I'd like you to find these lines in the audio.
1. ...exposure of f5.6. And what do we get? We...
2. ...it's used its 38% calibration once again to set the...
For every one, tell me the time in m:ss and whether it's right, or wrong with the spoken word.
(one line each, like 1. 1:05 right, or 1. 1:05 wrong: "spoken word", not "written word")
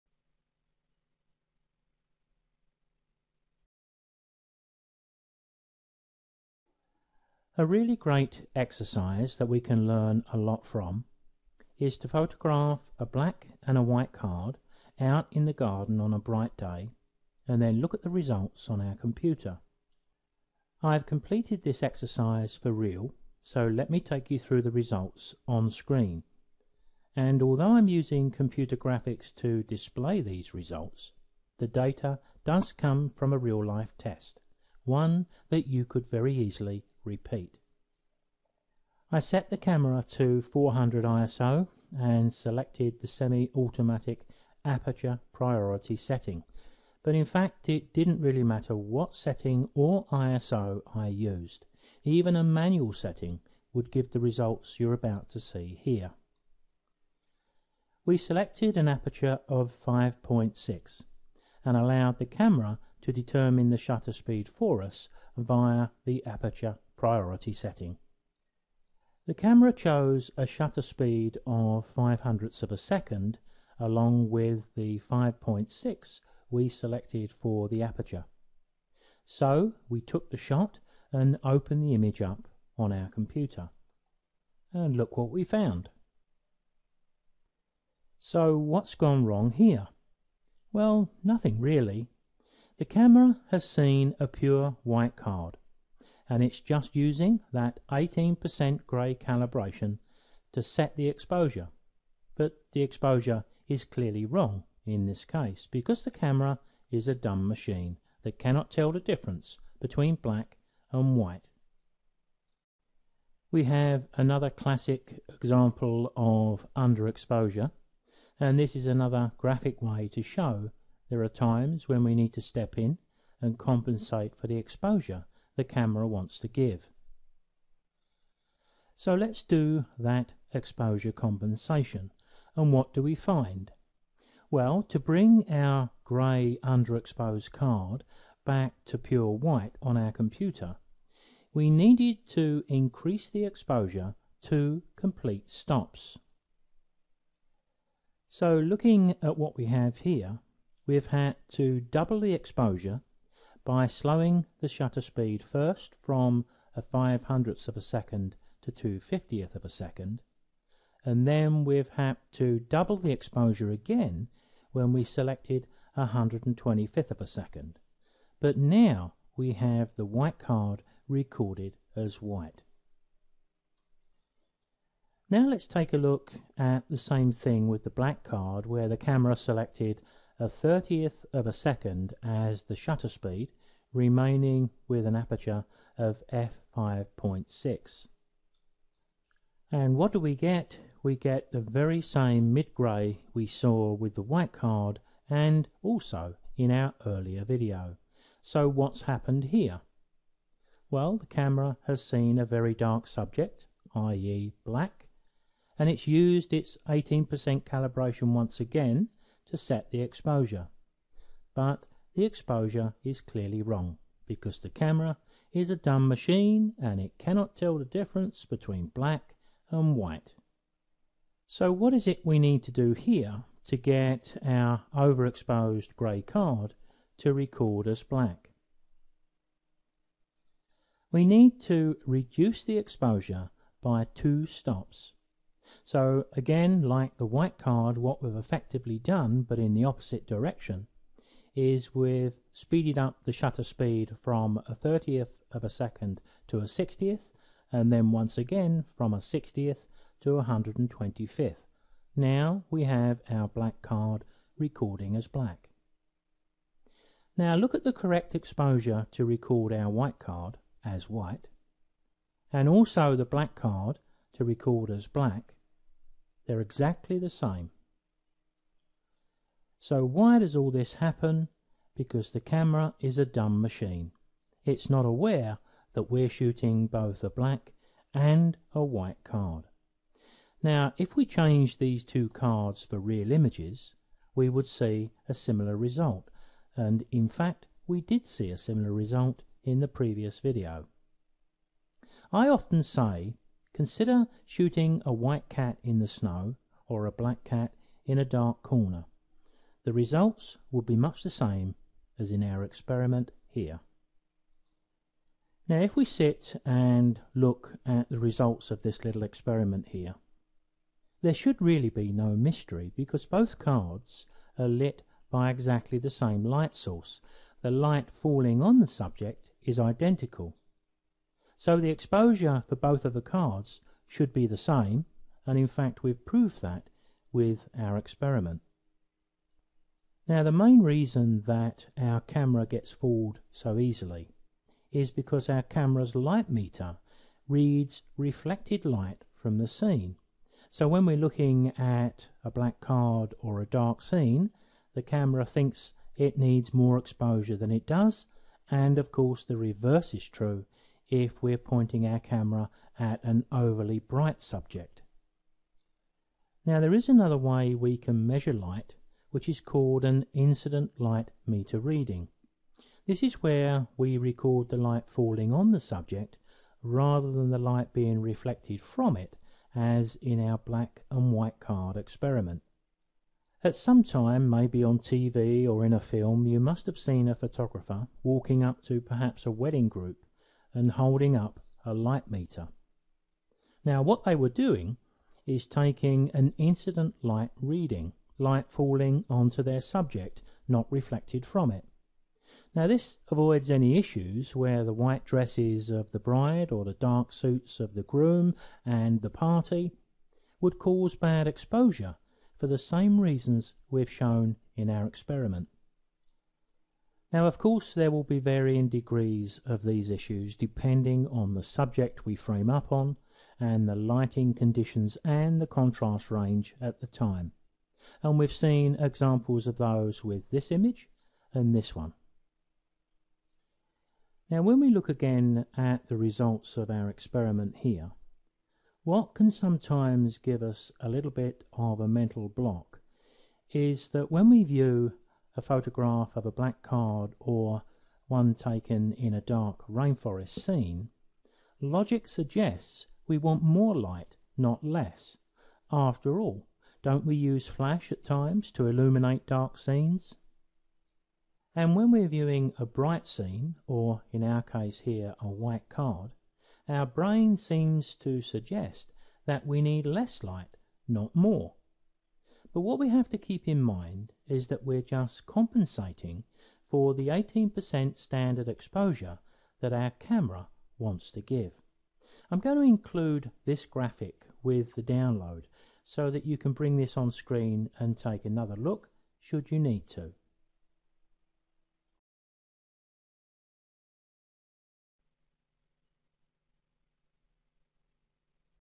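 1. 3:05 wrong: "aperture", not "exposure"
2. 3:25 wrong: "18", not "38".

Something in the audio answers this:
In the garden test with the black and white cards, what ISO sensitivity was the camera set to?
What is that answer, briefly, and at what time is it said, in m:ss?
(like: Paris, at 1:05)
400, at 0:40.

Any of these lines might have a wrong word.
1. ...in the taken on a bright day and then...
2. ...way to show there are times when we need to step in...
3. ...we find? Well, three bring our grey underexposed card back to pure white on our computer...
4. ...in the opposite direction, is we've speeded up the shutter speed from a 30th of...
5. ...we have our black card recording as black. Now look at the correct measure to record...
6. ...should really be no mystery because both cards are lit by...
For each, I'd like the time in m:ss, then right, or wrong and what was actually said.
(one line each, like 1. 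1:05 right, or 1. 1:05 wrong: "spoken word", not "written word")
1. 0:15 wrong: "garden", not "taken"
2. 1:59 right
3. 2:13 wrong: "two", not "three"
4. 3:59 right
5. 4:12 wrong: "exposure", not "measure"
6. 5:11 right.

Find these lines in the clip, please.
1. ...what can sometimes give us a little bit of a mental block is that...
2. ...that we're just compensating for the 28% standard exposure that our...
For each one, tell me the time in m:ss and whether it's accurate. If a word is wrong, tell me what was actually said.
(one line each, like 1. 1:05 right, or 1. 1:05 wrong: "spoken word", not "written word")
1. 7:09 right
2. 7:44 wrong: "18", not "28".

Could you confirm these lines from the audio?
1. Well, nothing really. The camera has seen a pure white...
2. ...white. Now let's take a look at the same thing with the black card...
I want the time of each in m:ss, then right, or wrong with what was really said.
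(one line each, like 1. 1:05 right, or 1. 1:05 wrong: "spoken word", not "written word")
1. 1:30 right
2. 2:52 right.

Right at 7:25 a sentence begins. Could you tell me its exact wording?
After all, don't we use flash at times to illuminate dark scenes?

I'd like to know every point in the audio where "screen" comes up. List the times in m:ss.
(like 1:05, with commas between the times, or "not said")
0:25, 7:57.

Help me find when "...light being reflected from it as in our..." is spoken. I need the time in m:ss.
6:07.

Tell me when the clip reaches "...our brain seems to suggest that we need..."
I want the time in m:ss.
7:36.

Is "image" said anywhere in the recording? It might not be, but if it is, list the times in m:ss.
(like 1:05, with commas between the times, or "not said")
1:21, 4:43, 7:00.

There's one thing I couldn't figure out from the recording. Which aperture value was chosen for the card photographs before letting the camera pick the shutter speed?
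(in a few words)
5.6.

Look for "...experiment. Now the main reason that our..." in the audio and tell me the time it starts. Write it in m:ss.
5:27.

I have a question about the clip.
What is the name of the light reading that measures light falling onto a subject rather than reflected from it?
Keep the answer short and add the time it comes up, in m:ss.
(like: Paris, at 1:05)
Incident light meter reading, at 6:00.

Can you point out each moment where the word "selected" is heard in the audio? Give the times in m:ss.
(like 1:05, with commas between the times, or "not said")
0:42, 0:58, 1:16, 2:45, 2:59.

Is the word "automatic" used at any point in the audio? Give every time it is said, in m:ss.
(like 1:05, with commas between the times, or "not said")
0:43.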